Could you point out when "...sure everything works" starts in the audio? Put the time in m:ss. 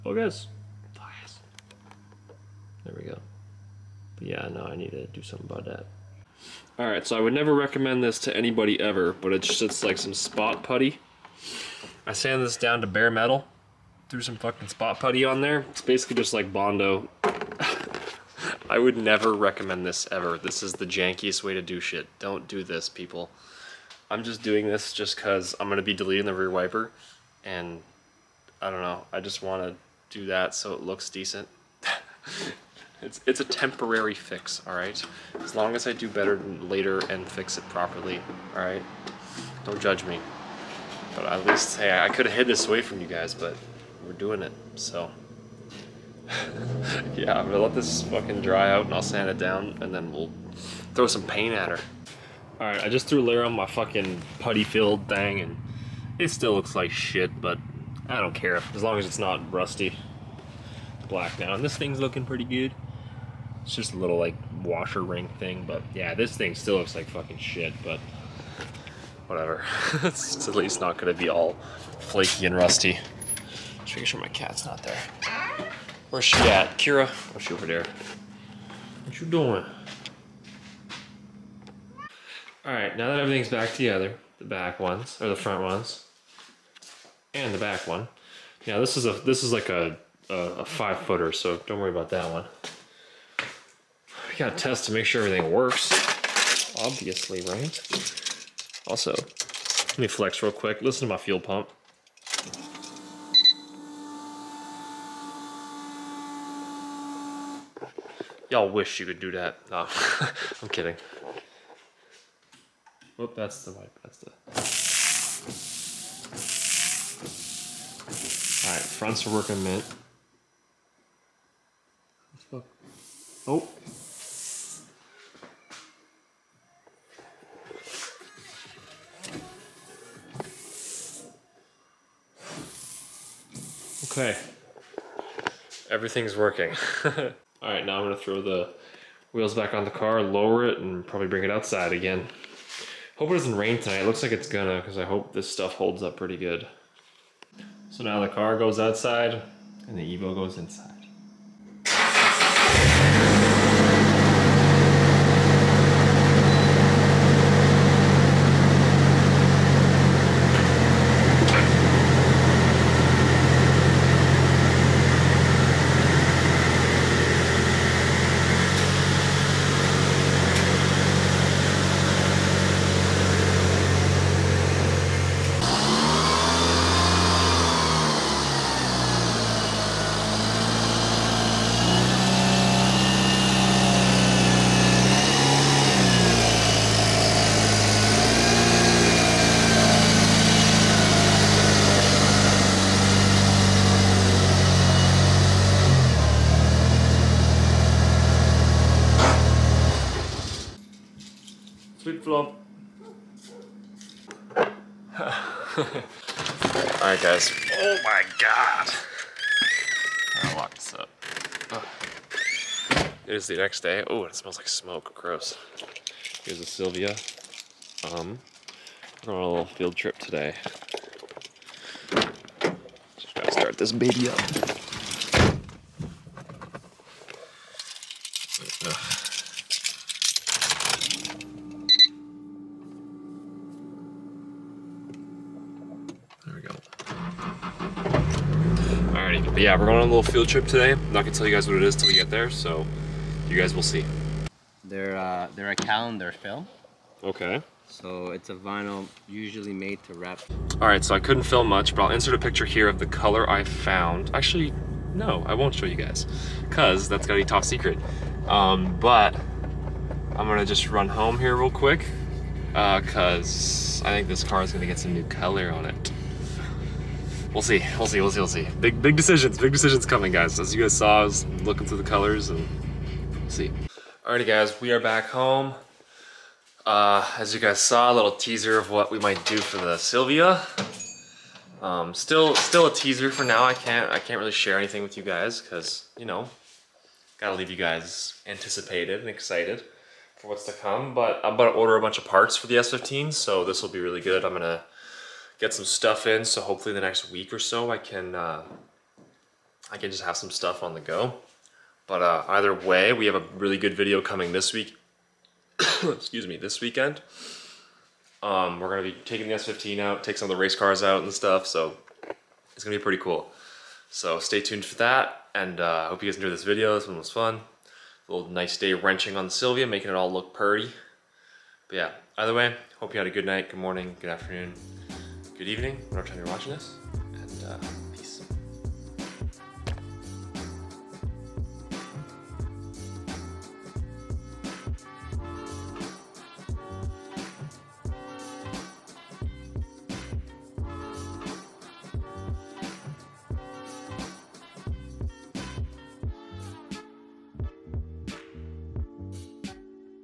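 1:35.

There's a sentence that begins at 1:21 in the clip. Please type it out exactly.
All right, now that everything's back together, the back ones, or the front ones, and the back one.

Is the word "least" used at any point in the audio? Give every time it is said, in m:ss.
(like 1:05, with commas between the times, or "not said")
0:41, 1:10.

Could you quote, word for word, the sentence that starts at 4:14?
Actually, no, I won't show you guys, cause that's gotta be top secret.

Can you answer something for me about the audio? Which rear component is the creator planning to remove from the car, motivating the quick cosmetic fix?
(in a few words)
rear wiper.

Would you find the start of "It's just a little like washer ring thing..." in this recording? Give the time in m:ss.
1:03.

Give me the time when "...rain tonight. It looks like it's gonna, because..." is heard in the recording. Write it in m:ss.
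2:23.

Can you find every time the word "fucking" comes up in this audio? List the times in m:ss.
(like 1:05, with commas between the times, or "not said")
0:14, 0:48, 0:53, 1:07.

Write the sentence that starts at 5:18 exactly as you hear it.
A little nice day wrenching on the Silvia, making it all look purty.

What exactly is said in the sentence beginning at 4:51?
But I'm about to order a bunch of parts for the S15, so this will be really good.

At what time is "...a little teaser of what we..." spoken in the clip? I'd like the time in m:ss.
4:38.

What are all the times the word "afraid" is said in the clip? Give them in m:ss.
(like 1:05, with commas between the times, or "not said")
not said.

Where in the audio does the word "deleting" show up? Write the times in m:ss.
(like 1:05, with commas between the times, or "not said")
0:25.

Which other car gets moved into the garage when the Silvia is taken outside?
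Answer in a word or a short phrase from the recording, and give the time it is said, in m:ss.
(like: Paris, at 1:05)
Evo, at 2:30.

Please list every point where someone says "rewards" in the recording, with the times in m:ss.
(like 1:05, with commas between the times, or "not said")
not said.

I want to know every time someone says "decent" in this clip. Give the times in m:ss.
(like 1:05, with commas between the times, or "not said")
0:31.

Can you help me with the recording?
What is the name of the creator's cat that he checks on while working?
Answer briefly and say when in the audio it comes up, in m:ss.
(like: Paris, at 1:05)
Kira, at 1:16.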